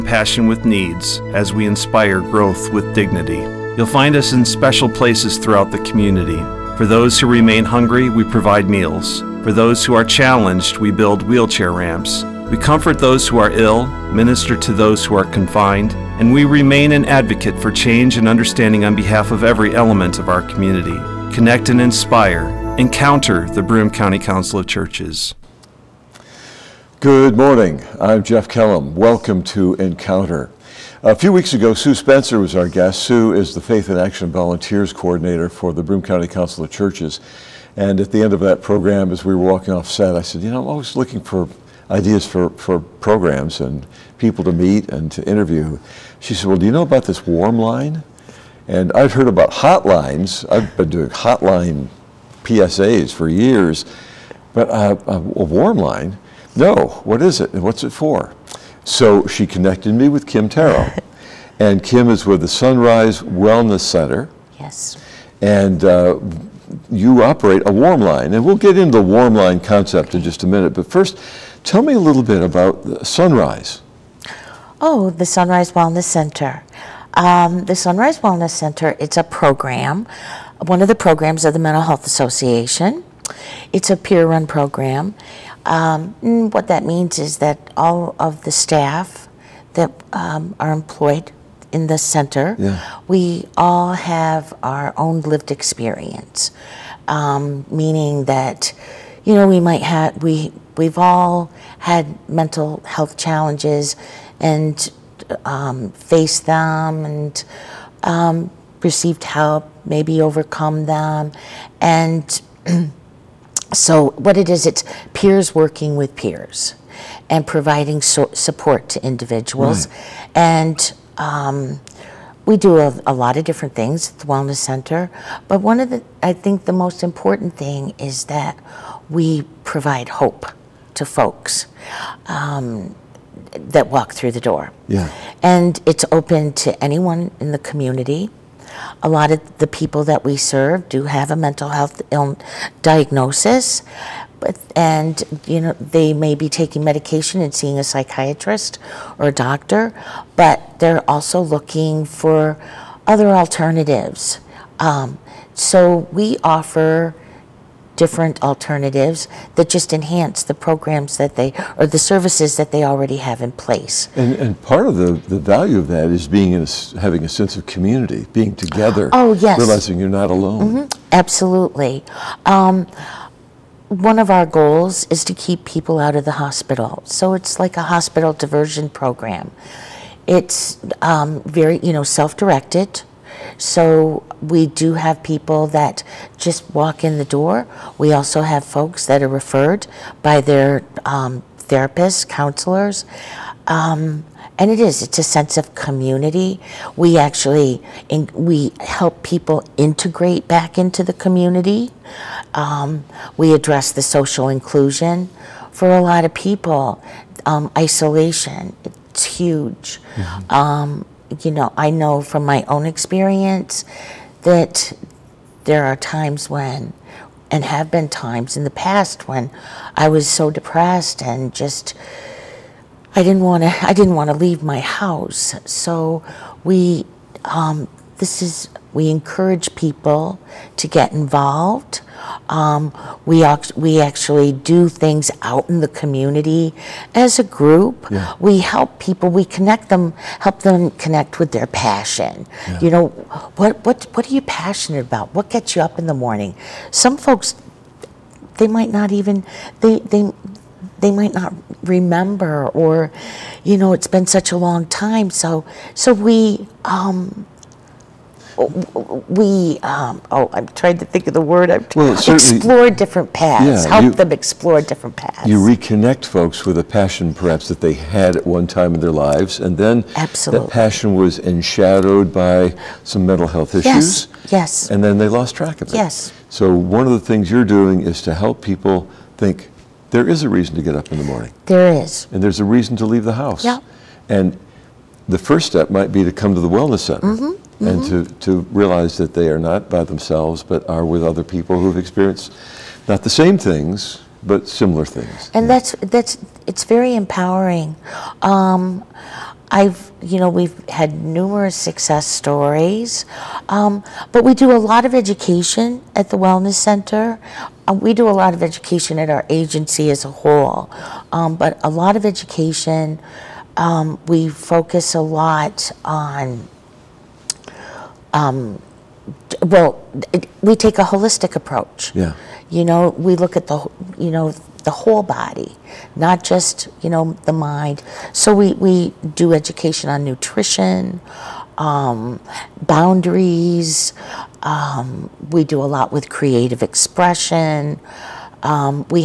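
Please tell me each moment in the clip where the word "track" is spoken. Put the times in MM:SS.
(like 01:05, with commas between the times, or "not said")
04:35.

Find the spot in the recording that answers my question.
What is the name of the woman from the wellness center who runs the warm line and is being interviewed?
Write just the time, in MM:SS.
01:00.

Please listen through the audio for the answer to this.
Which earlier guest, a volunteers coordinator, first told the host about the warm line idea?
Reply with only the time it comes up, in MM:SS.
00:31.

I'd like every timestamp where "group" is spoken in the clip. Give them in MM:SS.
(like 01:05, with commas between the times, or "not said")
03:57.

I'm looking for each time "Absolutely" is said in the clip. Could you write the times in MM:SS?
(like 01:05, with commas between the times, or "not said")
02:51, 04:30.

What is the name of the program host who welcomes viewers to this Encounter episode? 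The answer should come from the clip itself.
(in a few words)
Jeff Kellam.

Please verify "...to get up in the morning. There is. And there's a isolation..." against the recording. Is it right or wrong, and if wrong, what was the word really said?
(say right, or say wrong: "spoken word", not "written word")
wrong: "reason", not "isolation".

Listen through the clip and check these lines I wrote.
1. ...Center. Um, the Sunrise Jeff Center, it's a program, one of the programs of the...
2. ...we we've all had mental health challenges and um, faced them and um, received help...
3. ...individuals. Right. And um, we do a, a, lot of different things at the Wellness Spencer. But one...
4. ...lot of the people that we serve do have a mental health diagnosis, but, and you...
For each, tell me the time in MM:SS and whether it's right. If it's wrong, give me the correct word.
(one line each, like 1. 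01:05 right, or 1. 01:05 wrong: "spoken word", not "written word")
1. 01:16 wrong: "Wellness", not "Jeff"
2. 01:40 right
3. 01:59 wrong: "Center", not "Spencer"
4. 02:19 right.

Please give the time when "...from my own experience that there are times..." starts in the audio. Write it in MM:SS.
03:32.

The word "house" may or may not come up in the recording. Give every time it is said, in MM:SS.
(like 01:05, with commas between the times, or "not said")
03:44, 04:43.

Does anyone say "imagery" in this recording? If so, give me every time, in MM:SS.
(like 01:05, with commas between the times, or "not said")
not said.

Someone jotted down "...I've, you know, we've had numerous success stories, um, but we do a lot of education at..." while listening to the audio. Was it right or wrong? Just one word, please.
right.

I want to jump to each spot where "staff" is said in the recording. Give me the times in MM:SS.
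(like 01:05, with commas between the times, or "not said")
01:28.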